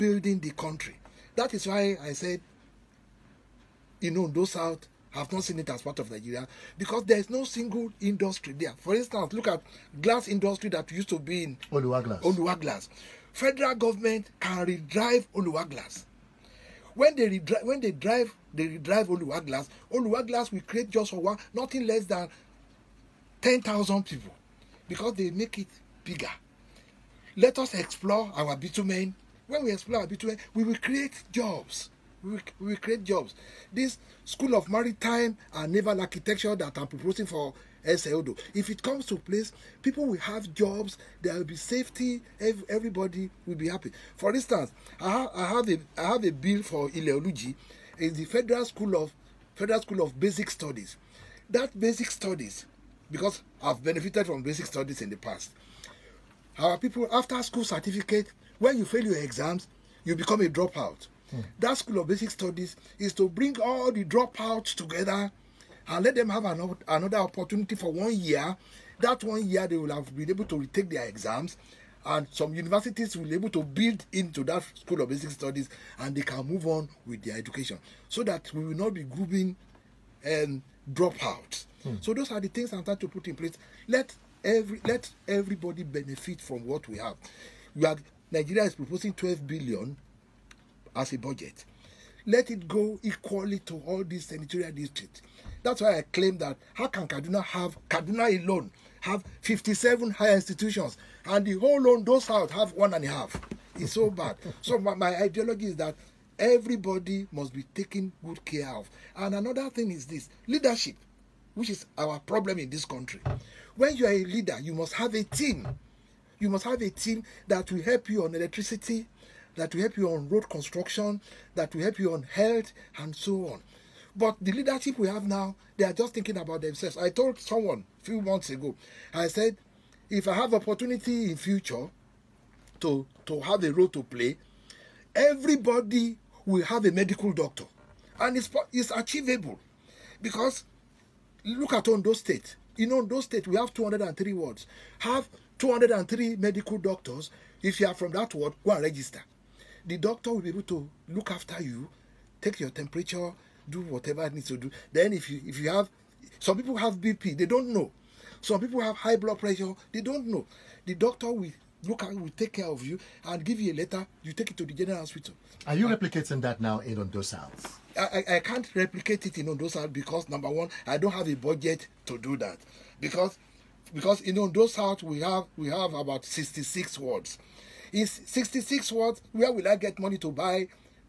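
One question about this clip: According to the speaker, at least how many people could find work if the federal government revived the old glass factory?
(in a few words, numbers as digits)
10,000.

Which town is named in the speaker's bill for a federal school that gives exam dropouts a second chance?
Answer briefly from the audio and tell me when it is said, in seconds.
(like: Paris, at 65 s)
Ileoluji, at 46 s.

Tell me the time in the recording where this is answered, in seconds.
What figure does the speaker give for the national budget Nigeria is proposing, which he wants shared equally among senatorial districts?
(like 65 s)
89 s.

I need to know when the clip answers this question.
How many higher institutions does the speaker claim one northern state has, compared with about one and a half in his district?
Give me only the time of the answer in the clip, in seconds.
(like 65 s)
99 s.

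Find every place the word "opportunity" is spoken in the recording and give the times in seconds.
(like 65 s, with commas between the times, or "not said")
67 s, 130 s.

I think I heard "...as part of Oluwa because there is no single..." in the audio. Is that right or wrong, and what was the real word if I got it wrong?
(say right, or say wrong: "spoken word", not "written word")
wrong: "Nigeria", not "Oluwa".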